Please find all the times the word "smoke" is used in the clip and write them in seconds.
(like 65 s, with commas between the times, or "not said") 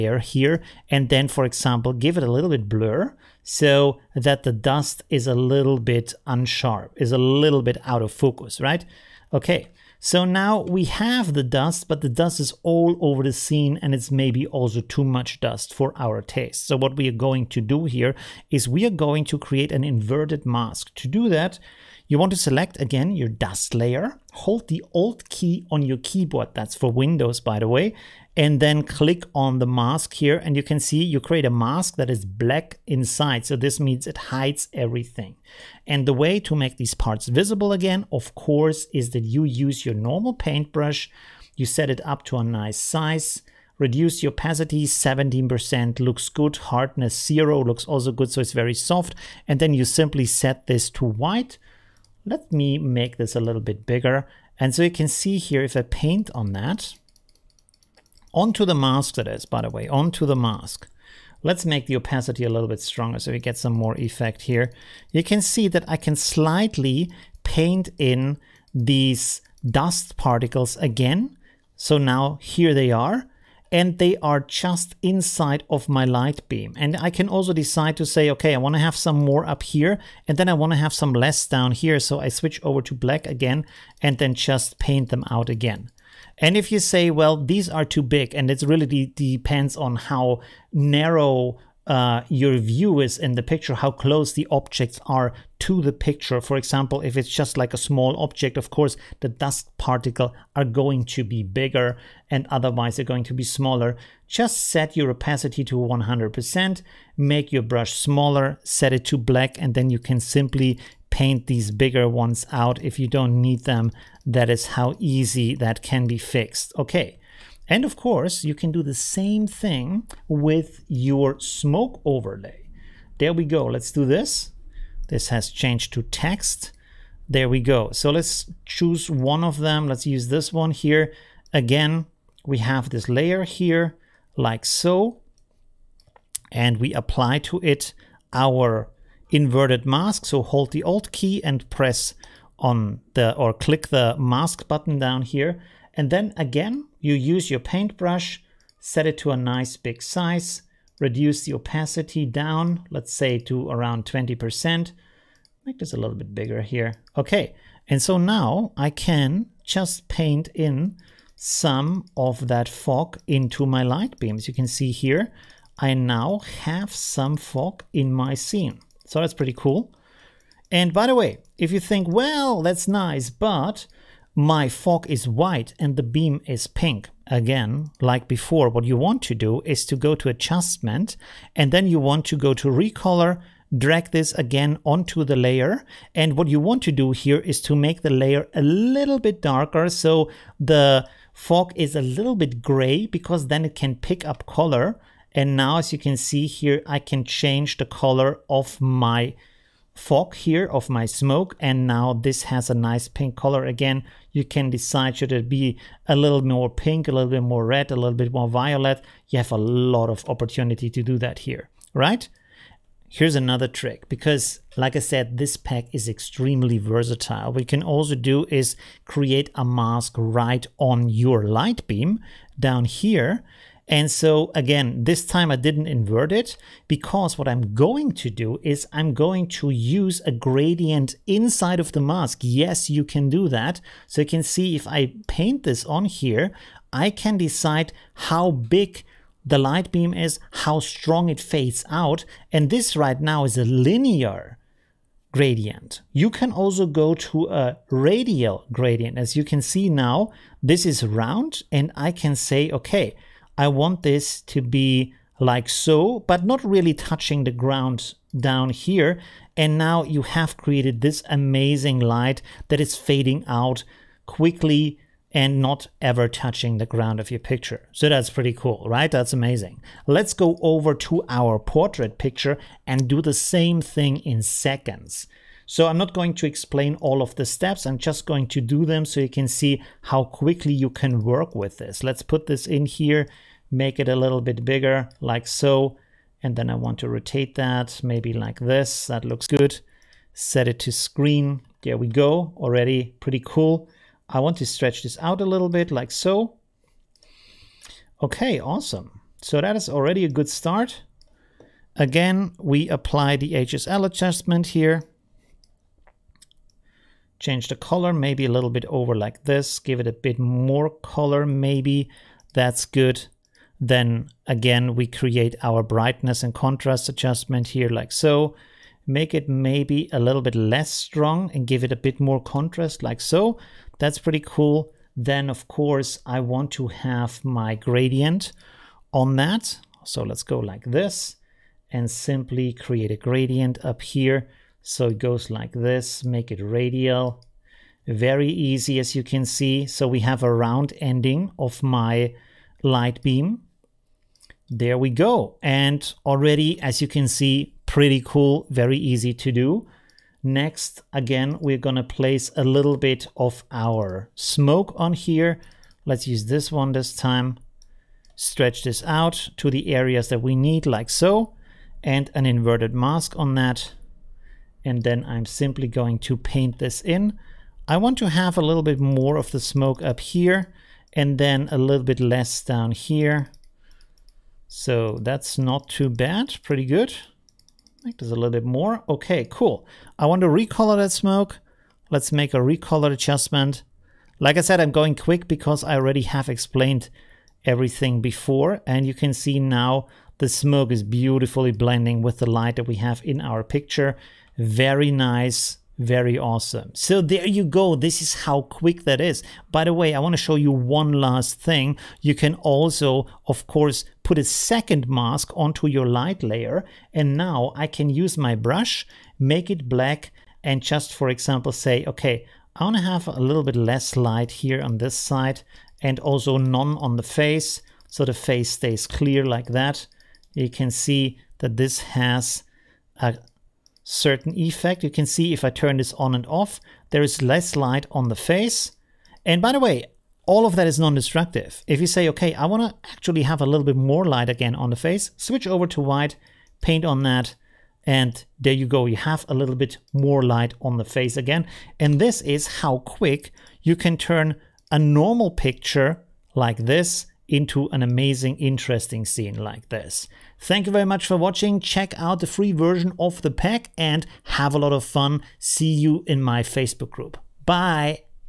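121 s, 201 s, 354 s, 369 s, 381 s, 390 s.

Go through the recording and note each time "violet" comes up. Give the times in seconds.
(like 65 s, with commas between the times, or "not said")
208 s.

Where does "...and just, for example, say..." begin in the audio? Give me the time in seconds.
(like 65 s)
410 s.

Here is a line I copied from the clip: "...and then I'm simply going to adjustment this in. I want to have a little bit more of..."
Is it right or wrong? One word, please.
wrong.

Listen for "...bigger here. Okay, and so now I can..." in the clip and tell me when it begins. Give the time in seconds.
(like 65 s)
156 s.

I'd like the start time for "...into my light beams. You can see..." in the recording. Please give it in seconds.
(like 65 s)
163 s.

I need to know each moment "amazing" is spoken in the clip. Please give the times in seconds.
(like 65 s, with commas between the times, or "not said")
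261 s, 269 s, 448 s.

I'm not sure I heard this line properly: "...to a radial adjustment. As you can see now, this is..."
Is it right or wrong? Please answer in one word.
wrong.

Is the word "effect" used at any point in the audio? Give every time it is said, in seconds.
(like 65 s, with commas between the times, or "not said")
63 s, 424 s.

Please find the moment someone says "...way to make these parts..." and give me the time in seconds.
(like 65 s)
36 s.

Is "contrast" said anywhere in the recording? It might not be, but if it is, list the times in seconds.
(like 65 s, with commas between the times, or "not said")
316 s, 322 s.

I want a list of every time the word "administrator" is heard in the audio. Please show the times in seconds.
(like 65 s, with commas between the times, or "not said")
not said.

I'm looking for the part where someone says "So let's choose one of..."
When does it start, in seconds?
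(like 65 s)
127 s.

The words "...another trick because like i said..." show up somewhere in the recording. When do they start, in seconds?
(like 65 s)
213 s.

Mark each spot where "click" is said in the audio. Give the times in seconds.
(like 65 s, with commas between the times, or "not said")
28 s, 143 s.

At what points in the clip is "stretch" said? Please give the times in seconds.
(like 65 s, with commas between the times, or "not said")
294 s, 358 s.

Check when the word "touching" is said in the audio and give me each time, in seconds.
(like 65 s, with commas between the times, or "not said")
256 s, 266 s.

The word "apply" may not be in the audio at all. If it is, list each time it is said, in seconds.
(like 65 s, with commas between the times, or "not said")
136 s, 302 s.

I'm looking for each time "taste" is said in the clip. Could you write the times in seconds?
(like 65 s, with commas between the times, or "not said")
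16 s.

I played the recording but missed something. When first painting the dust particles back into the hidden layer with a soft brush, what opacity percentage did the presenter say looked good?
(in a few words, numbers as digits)
17%.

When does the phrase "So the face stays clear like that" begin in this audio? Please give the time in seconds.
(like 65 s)
418 s.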